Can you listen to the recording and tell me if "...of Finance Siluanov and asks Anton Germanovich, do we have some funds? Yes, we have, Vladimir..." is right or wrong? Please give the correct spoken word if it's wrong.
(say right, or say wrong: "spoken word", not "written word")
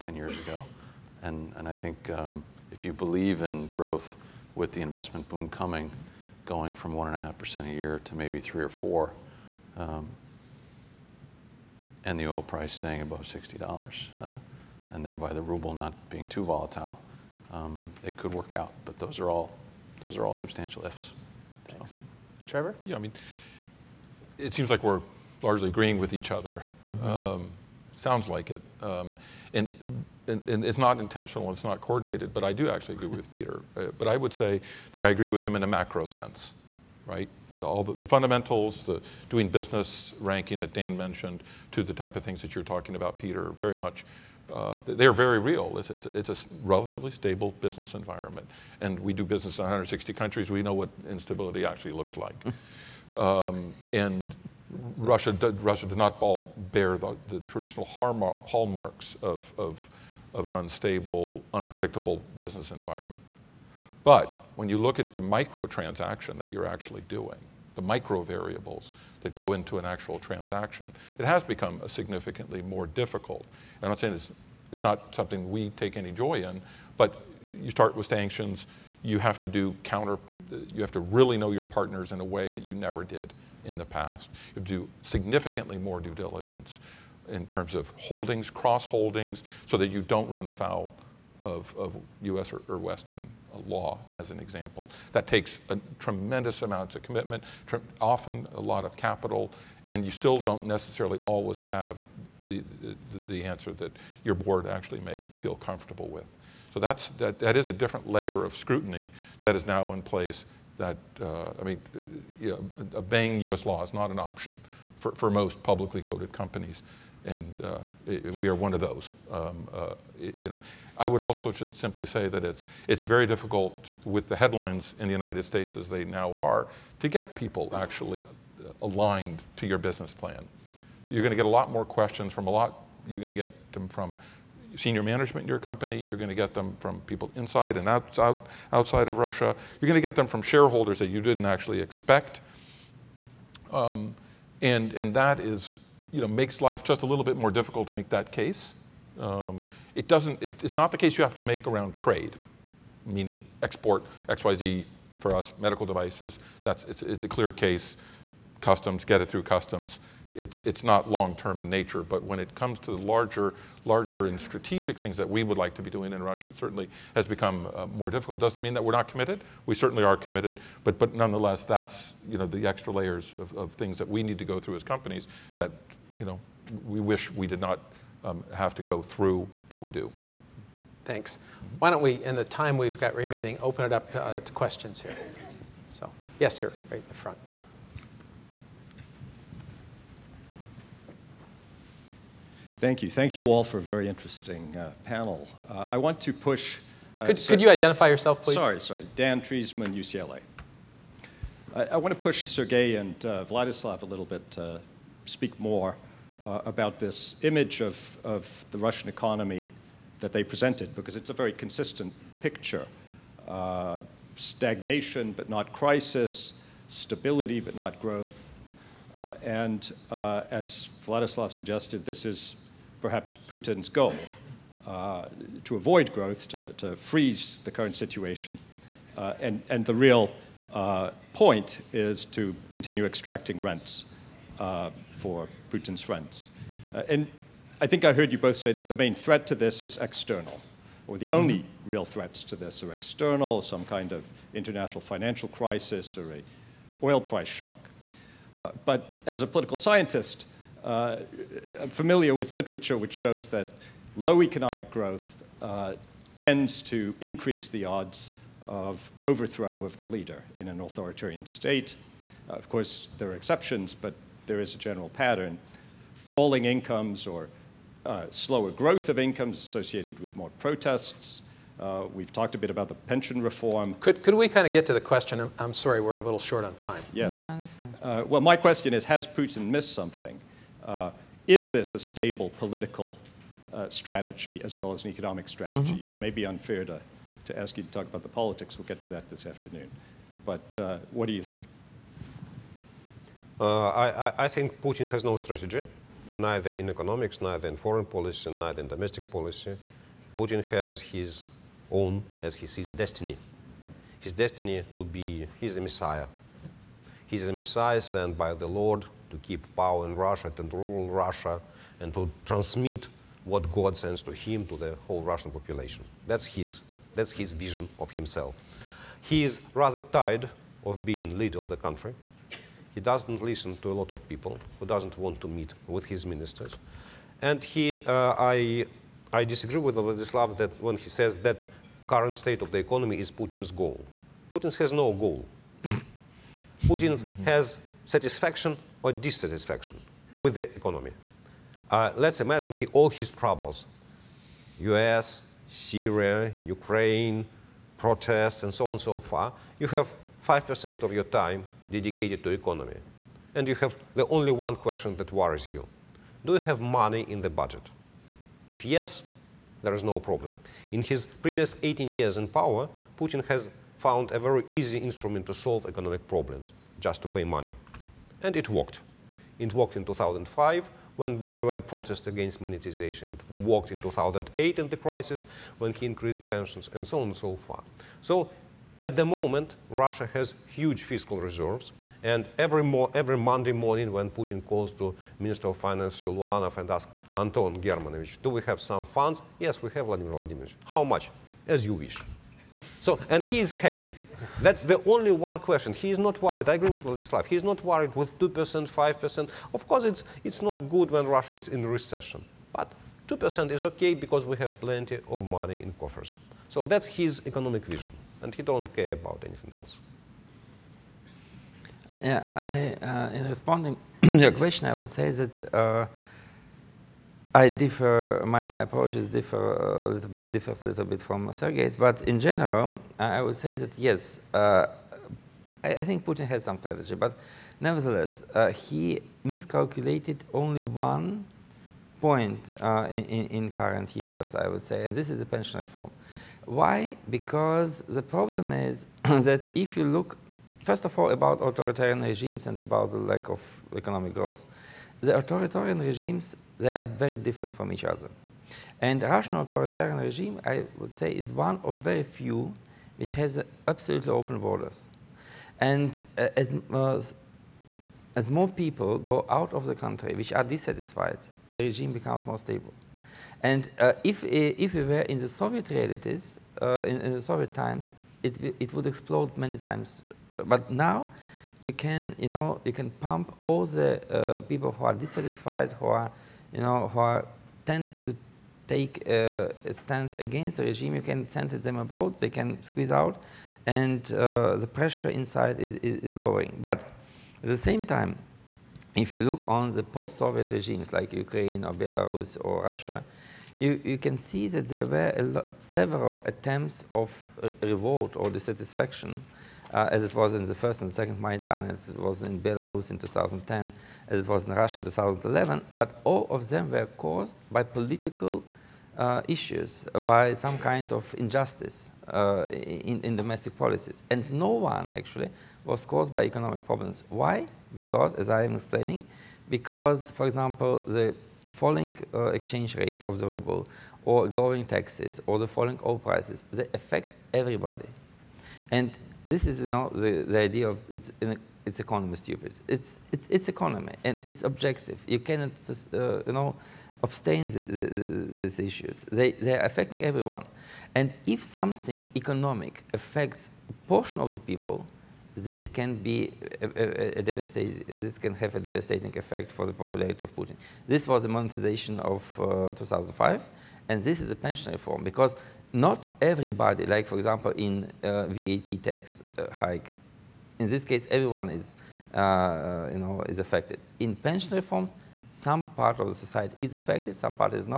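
right.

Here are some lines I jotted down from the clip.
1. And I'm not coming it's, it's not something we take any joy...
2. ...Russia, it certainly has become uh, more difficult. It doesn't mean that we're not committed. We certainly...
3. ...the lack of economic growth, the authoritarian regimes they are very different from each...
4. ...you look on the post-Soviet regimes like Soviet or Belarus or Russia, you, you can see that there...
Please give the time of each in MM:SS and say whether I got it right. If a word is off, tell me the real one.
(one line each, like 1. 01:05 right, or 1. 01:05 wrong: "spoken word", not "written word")
1. 01:13 wrong: "saying", not "coming"
2. 02:46 right
3. 07:23 right
4. 08:09 wrong: "Ukraine", not "Soviet".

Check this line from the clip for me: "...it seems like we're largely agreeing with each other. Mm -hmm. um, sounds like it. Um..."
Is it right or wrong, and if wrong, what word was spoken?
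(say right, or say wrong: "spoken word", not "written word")
right.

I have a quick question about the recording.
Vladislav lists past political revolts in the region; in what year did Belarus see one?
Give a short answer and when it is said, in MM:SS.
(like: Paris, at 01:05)
2010, at 08:23.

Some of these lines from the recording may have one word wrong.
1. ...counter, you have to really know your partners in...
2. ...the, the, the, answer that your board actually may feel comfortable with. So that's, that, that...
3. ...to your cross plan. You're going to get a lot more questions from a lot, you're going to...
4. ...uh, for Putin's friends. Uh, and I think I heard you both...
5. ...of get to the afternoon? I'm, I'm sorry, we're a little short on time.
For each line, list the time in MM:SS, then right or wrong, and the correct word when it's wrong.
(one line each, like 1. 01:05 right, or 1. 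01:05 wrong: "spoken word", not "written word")
1. 01:19 right
2. 01:42 right
3. 02:09 wrong: "business", not "cross"
4. 03:54 right
5. 04:34 wrong: "question", not "afternoon".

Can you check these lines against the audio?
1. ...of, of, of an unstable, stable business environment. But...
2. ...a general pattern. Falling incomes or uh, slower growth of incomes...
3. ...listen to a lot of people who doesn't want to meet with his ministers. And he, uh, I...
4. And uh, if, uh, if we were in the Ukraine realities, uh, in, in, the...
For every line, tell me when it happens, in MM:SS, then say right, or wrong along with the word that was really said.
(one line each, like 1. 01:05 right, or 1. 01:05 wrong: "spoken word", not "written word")
1. 00:59 wrong: "unpredictable", not "stable"
2. 04:24 right
3. 05:23 right
4. 07:43 wrong: "Soviet", not "Ukraine".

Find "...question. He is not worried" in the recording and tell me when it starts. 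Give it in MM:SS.
06:35.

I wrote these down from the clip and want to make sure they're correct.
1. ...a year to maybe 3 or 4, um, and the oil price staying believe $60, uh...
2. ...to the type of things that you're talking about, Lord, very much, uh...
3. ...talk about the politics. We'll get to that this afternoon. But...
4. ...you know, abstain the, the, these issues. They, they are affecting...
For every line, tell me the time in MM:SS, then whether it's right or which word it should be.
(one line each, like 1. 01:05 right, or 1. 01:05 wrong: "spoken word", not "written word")
1. 00:07 wrong: "above", not "believe"
2. 00:41 wrong: "Peter", not "Lord"
3. 04:47 right
4. 08:56 right.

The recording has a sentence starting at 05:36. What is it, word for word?
Putin has satisfaction or dissatisfaction with the economy.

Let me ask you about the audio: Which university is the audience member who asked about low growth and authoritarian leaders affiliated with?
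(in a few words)
UCLA.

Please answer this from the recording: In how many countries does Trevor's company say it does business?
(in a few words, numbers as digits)
160.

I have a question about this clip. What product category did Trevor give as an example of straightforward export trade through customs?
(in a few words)
medical devices.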